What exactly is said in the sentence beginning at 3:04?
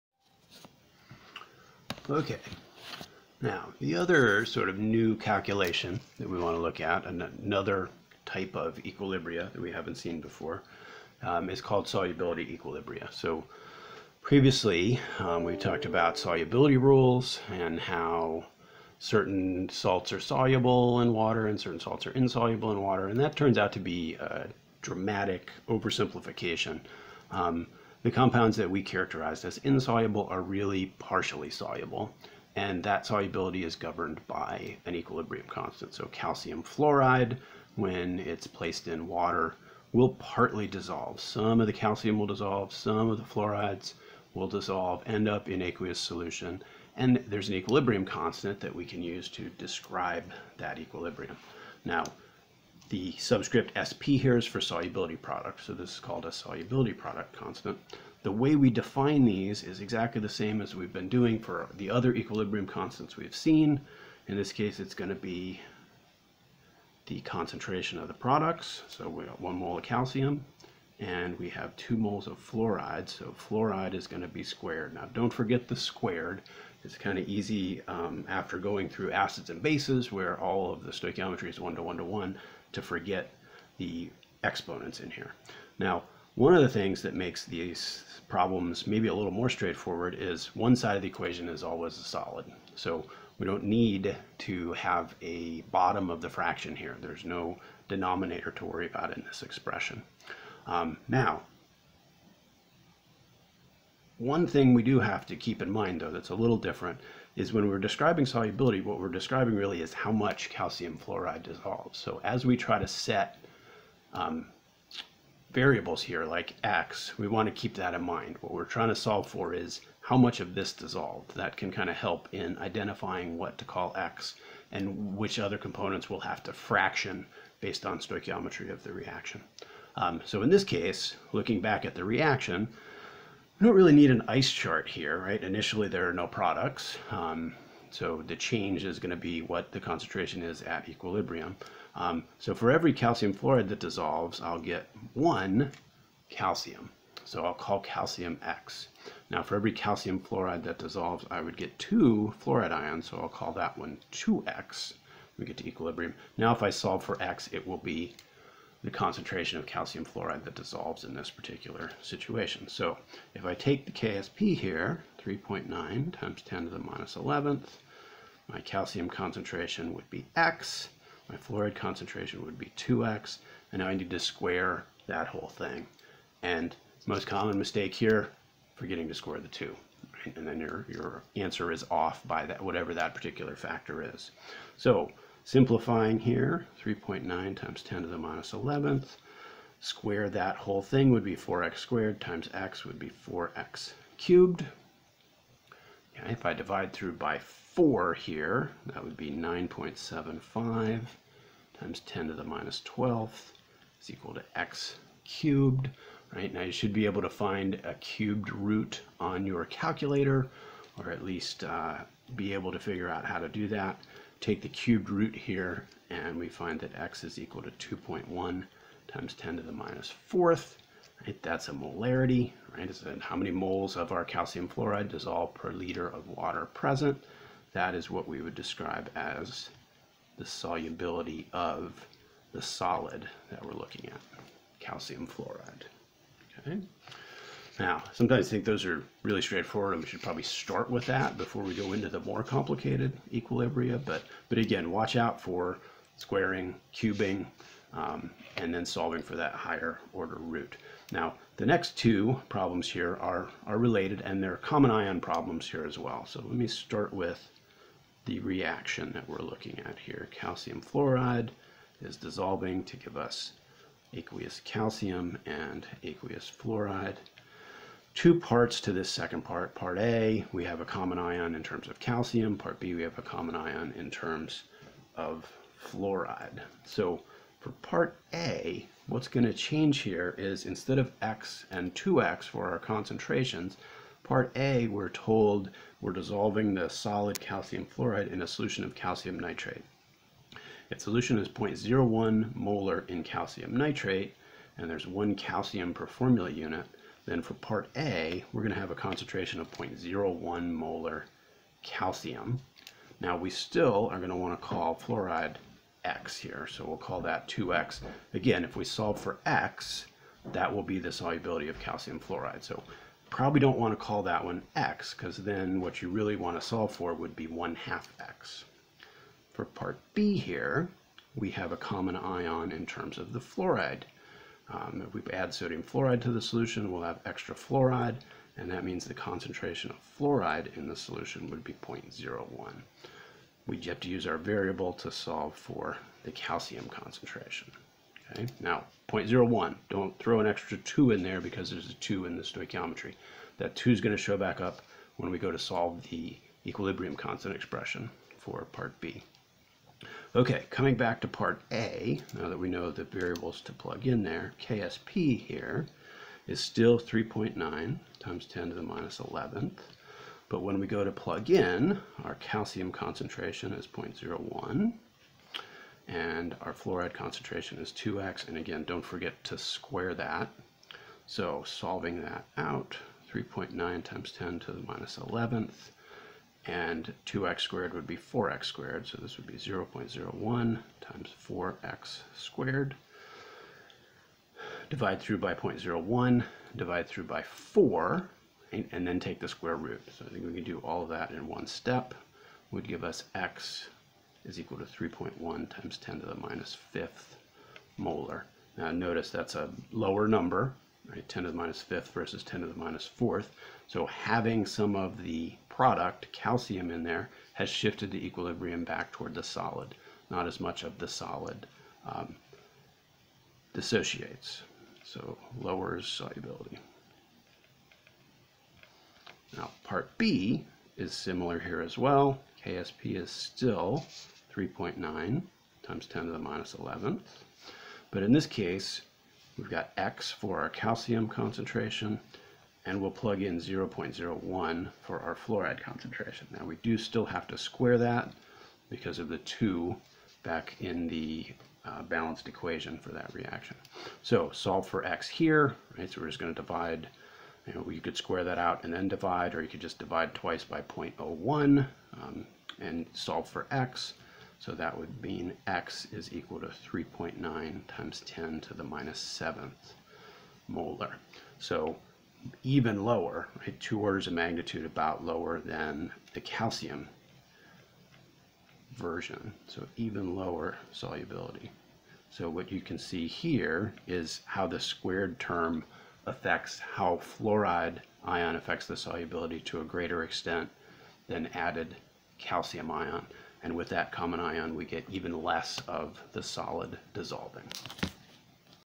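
So Simplifying here, 3.9 times 10 to the minus 11th.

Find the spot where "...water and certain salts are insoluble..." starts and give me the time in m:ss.
0:21.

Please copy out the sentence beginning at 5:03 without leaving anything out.
Now we still are going to want to call fluoride x here, so we'll call that 2x.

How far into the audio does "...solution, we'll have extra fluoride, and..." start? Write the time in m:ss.
5:26.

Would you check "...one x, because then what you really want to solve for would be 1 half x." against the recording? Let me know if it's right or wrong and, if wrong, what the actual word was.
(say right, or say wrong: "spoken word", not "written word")
right.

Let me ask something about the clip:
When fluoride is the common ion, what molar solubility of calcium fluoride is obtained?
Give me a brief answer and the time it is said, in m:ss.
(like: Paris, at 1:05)
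3.9 x 10^-7 M, at 7:36.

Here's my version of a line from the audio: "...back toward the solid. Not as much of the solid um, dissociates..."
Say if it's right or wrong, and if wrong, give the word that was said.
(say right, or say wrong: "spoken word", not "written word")
right.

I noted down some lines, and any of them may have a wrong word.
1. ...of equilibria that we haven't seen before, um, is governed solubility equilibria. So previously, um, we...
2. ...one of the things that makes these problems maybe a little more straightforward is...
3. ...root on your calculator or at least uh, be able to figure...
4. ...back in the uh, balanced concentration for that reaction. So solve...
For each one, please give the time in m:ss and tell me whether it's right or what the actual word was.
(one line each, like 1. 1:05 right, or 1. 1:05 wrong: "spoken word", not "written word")
1. 0:08 wrong: "called", not "governed"
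2. 1:26 right
3. 3:28 right
4. 7:20 wrong: "equation", not "concentration".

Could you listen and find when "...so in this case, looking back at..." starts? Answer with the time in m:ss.
2:10.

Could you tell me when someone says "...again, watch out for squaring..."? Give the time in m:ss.
4:04.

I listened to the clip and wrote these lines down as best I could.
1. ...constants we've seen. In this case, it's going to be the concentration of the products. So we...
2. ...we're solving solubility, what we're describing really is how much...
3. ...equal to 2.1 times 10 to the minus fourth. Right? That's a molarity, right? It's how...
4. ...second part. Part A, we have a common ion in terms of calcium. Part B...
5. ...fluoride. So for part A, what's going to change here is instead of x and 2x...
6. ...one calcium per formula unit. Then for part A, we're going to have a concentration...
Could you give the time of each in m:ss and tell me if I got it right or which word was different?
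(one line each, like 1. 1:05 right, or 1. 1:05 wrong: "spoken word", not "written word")
1. 1:02 right
2. 1:47 wrong: "describing", not "solving"
3. 3:37 right
4. 4:29 right
5. 4:35 right
6. 4:55 right.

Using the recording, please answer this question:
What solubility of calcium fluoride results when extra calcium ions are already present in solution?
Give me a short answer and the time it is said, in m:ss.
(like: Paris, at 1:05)
3.1 x 10^-5 M, at 6:34.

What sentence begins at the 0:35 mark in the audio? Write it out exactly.
So calcium fluoride, when it's placed in water, will partly dissolve.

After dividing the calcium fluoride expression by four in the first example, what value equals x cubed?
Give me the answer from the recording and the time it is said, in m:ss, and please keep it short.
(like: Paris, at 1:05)
9.75 x 10^-12, at 3:19.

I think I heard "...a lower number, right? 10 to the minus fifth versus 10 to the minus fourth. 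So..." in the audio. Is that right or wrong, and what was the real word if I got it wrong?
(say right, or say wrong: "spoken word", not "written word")
right.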